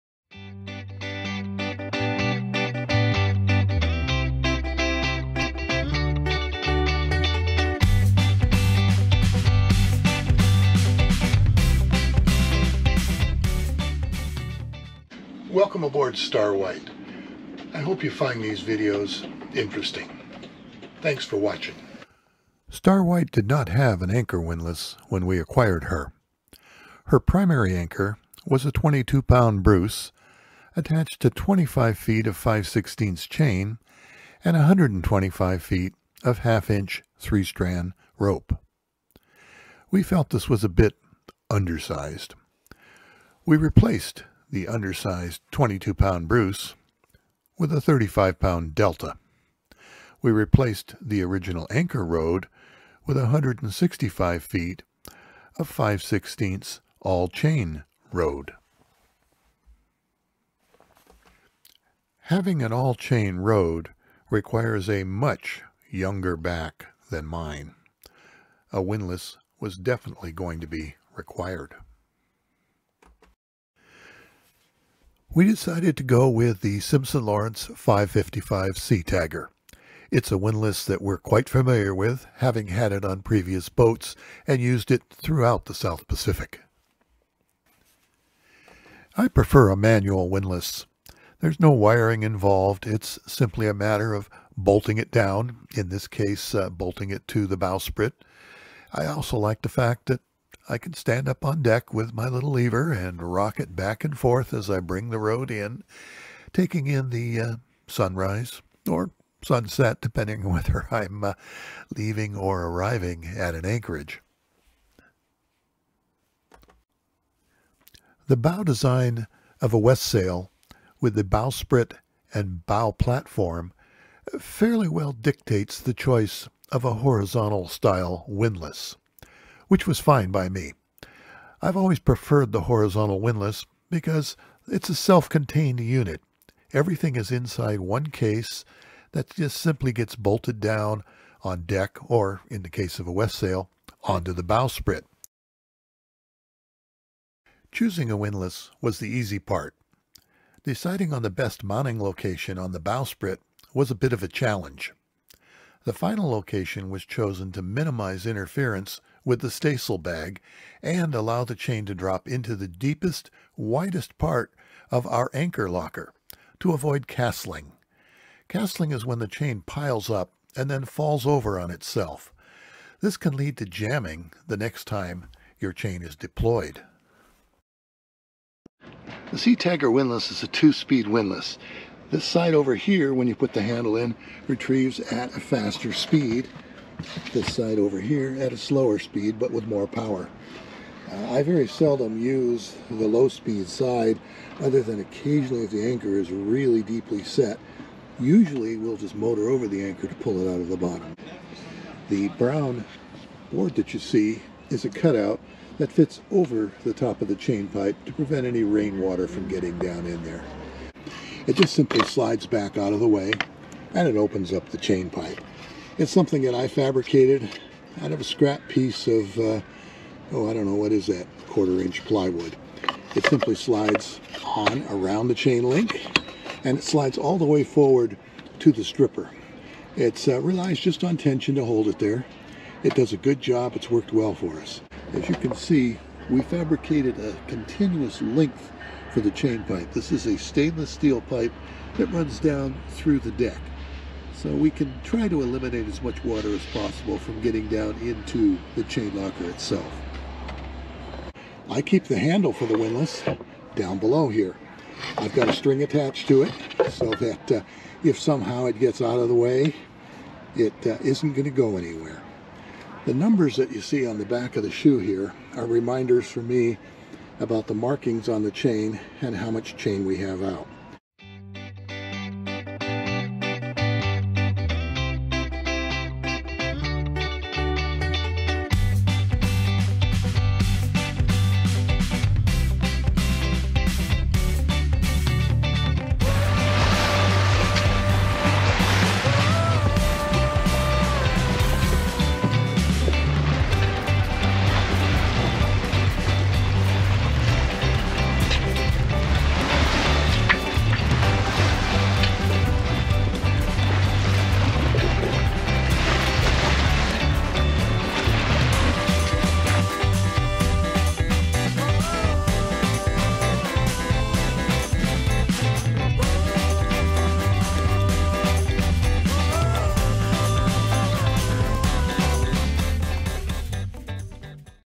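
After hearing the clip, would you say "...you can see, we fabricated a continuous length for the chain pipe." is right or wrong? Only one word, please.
right.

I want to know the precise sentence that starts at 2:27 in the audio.
Choosing a windlass was the easy part.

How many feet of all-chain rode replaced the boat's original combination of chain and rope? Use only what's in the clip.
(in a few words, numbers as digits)
165 feet.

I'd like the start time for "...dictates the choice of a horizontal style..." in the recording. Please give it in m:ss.
2:05.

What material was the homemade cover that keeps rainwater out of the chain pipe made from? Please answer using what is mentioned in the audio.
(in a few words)
Quarter inch plywood.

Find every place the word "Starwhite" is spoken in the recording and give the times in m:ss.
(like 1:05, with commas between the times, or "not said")
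0:16, 0:22.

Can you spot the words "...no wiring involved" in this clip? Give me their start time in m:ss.
1:31.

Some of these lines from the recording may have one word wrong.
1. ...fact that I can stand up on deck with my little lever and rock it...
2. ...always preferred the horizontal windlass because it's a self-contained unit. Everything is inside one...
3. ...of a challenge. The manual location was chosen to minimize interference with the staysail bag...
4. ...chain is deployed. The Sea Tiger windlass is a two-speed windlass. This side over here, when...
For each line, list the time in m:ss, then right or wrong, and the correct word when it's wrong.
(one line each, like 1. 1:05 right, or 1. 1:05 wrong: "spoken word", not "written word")
1. 1:39 right
2. 2:11 right
3. 2:34 wrong: "final", not "manual"
4. 2:55 right.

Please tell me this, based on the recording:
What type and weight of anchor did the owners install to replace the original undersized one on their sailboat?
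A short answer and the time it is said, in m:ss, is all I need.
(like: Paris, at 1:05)
35-pound Delta, at 0:47.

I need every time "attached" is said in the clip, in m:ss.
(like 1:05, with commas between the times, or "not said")
0:30, 4:15.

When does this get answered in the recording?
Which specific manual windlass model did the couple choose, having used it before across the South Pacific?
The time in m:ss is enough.
1:16.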